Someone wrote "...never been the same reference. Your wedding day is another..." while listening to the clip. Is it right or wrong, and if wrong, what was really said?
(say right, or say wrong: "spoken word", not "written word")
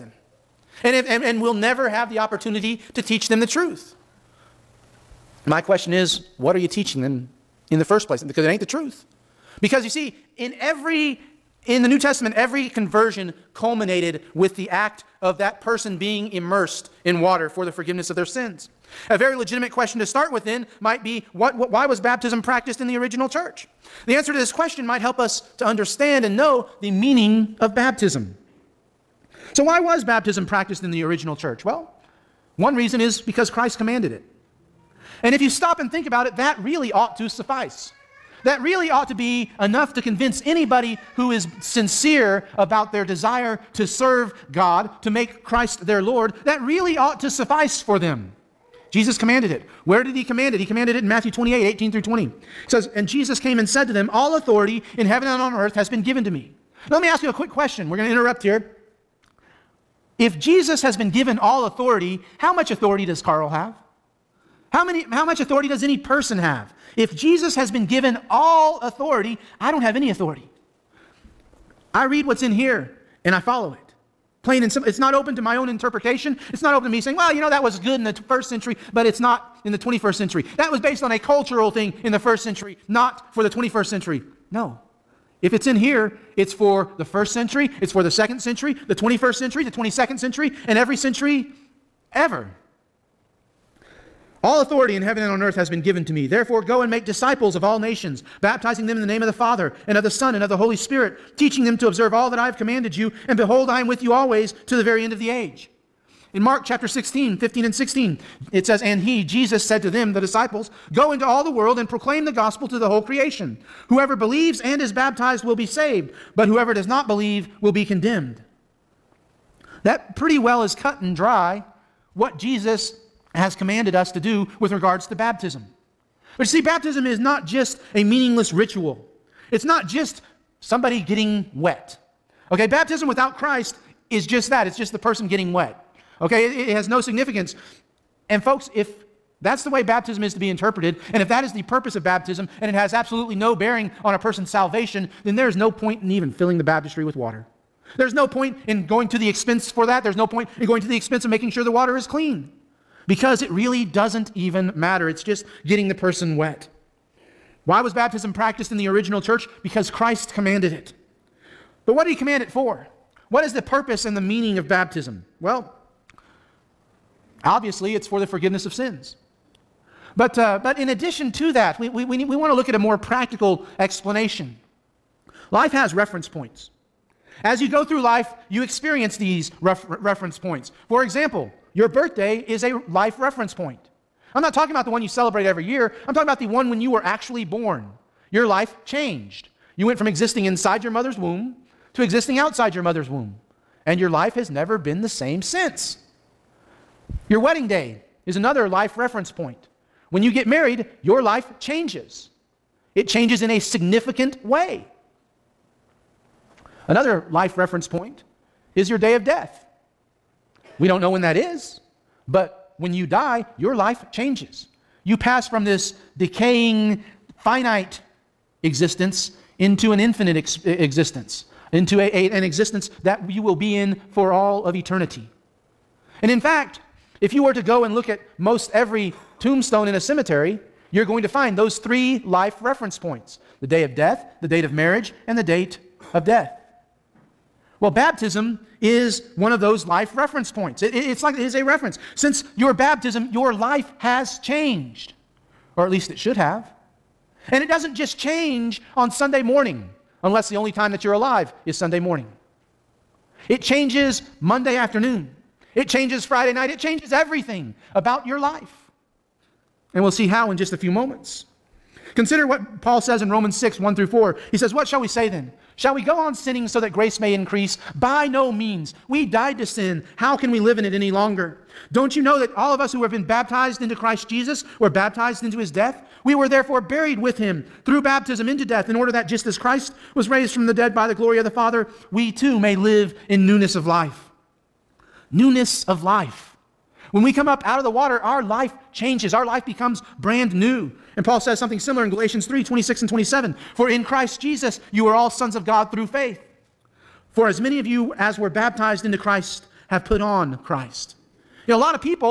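wrong: "since", not "reference".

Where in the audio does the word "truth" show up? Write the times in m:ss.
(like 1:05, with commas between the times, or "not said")
0:03, 0:08.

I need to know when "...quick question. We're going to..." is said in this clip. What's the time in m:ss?
0:57.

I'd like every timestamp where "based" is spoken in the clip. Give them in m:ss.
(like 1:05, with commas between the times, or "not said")
1:20.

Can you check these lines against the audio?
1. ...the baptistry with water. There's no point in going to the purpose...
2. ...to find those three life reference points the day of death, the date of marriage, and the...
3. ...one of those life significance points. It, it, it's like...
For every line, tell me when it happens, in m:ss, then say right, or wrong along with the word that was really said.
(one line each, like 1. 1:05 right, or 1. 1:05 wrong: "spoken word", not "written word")
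1. 2:26 wrong: "expense", not "purpose"
2. 3:51 right
3. 3:59 wrong: "reference", not "significance".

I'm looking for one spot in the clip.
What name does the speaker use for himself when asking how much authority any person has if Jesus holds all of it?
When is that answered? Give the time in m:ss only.
1:03.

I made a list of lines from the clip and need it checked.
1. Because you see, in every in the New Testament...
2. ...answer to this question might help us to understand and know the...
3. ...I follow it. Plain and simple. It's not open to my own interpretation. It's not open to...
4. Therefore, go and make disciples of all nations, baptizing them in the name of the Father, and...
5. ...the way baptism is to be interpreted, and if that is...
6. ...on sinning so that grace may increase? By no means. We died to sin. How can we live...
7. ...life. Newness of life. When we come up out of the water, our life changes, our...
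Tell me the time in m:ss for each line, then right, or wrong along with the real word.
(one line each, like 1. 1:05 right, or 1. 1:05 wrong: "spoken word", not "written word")
1. 0:09 right
2. 0:24 right
3. 1:13 right
4. 1:36 right
5. 2:19 right
6. 4:26 right
7. 4:43 right.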